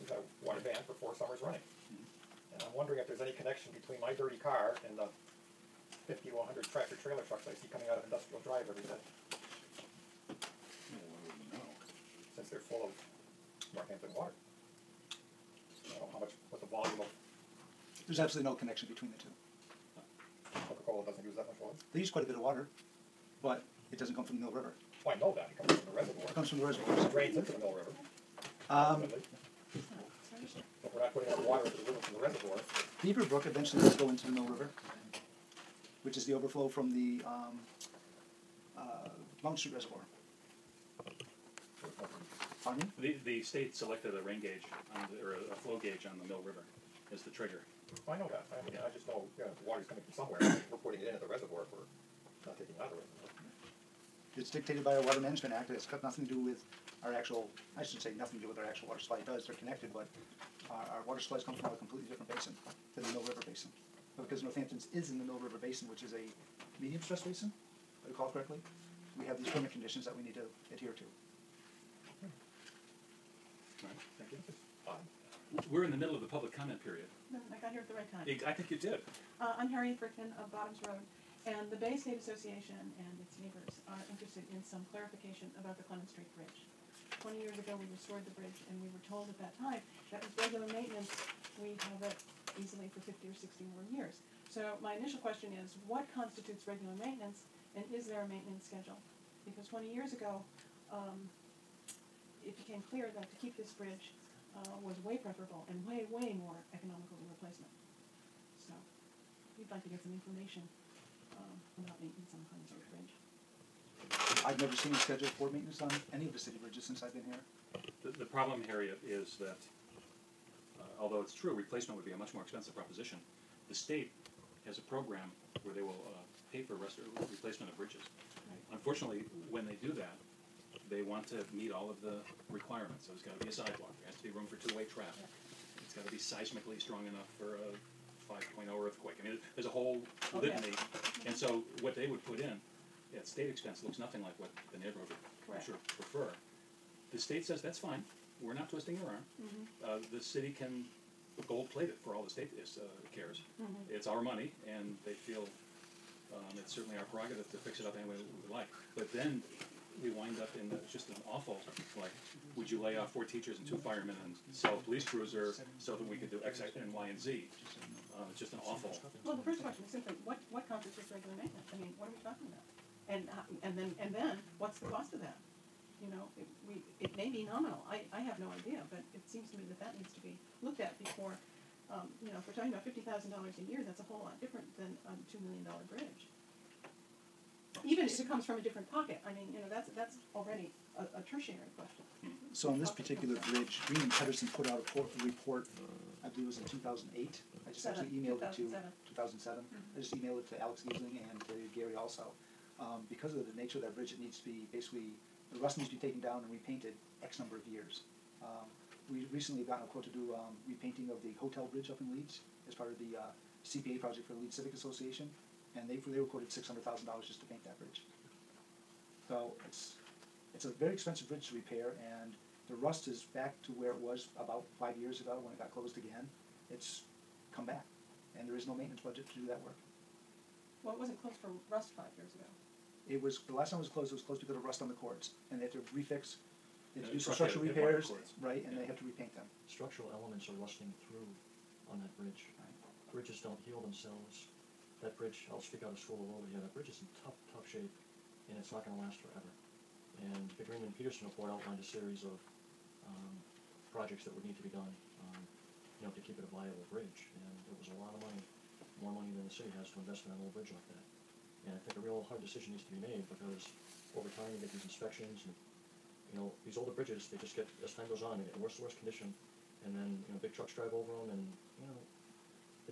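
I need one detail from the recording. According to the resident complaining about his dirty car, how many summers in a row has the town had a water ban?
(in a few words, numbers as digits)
4.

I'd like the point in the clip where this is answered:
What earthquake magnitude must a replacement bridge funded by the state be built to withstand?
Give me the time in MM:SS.
02:18.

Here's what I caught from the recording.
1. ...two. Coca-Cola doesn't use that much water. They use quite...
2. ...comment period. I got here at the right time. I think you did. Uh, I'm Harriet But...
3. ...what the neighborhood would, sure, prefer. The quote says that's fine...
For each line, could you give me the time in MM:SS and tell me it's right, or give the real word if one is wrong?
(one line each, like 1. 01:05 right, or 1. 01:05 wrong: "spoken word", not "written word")
1. 00:19 right
2. 01:16 wrong: "Brickman", not "But"
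3. 02:24 wrong: "state", not "quote".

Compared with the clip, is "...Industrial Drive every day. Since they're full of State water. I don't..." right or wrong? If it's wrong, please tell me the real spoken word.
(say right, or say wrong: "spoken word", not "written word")
wrong: "Northampton", not "State".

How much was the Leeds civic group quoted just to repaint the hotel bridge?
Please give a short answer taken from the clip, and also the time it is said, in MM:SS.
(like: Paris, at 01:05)
$600,000, at 03:36.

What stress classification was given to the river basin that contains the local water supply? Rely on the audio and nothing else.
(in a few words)
medium stress basin.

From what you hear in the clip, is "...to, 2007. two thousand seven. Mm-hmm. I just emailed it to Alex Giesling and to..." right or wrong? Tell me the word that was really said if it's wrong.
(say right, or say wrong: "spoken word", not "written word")
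right.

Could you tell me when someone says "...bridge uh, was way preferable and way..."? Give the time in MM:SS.
01:43.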